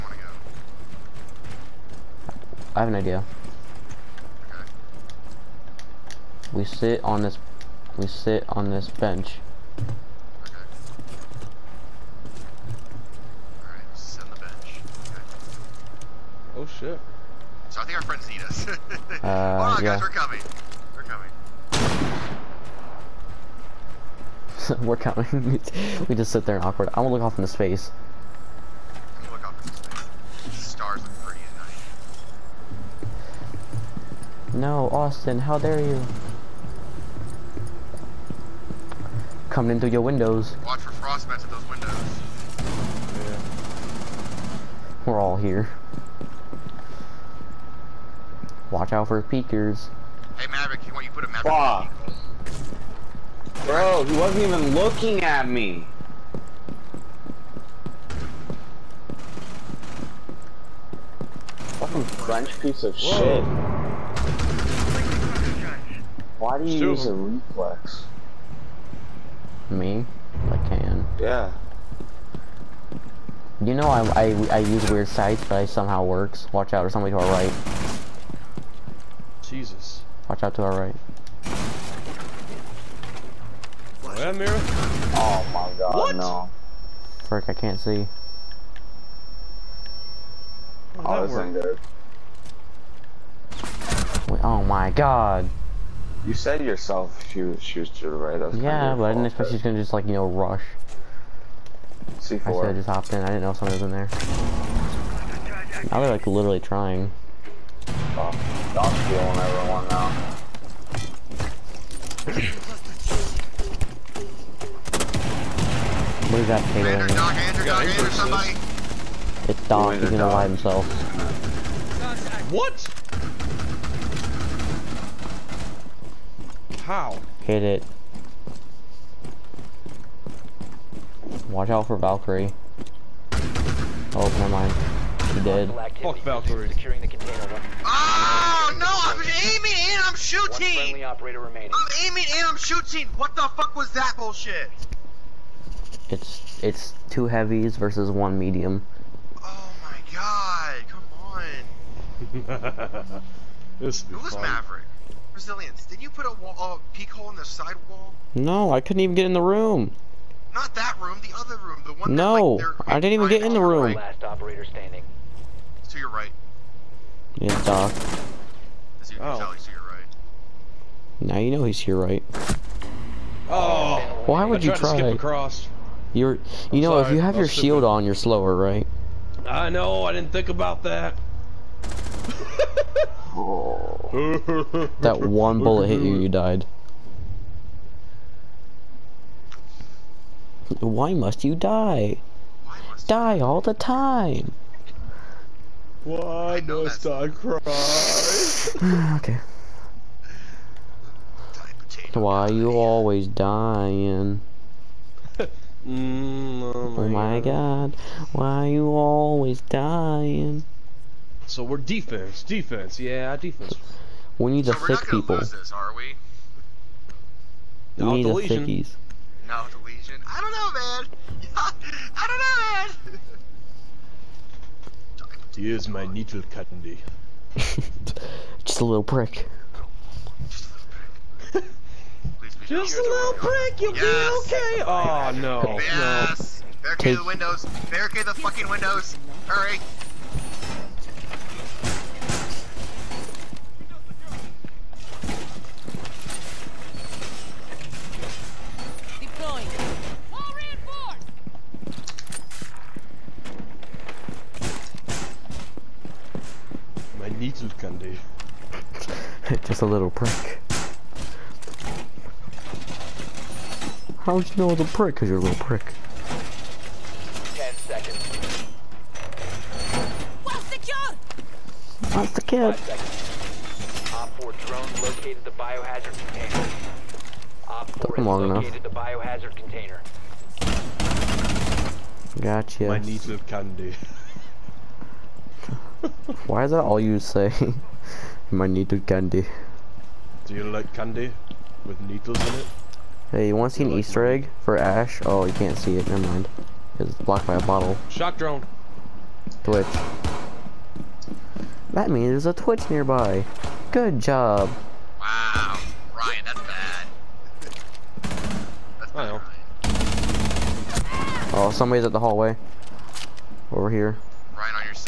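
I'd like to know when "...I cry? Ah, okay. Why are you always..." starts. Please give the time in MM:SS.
03:17.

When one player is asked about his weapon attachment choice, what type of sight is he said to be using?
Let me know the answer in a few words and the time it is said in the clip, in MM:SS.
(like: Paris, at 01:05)
Reflex, at 01:07.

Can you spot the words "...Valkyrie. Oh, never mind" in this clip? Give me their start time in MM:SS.
02:11.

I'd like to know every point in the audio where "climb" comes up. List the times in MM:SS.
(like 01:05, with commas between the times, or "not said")
not said.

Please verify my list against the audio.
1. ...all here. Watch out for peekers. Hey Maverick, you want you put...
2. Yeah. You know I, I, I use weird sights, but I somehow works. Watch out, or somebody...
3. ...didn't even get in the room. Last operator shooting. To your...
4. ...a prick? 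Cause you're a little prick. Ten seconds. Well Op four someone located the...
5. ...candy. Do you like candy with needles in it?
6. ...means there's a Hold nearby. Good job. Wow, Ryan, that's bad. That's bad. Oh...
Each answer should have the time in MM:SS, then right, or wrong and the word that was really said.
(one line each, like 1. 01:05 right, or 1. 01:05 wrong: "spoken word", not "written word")
1. 00:45 right
2. 01:11 right
3. 02:43 wrong: "standing", not "shooting"
4. 04:24 wrong: "drone", not "someone"
5. 04:49 right
6. 05:02 wrong: "Twitch", not "Hold".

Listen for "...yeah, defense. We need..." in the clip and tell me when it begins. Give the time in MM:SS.
03:32.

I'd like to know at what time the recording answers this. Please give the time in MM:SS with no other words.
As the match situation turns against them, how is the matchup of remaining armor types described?
02:27.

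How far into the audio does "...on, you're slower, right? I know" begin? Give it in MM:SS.
02:57.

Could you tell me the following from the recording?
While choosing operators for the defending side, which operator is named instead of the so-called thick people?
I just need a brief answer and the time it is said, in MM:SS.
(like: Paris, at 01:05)
Legion, at 03:39.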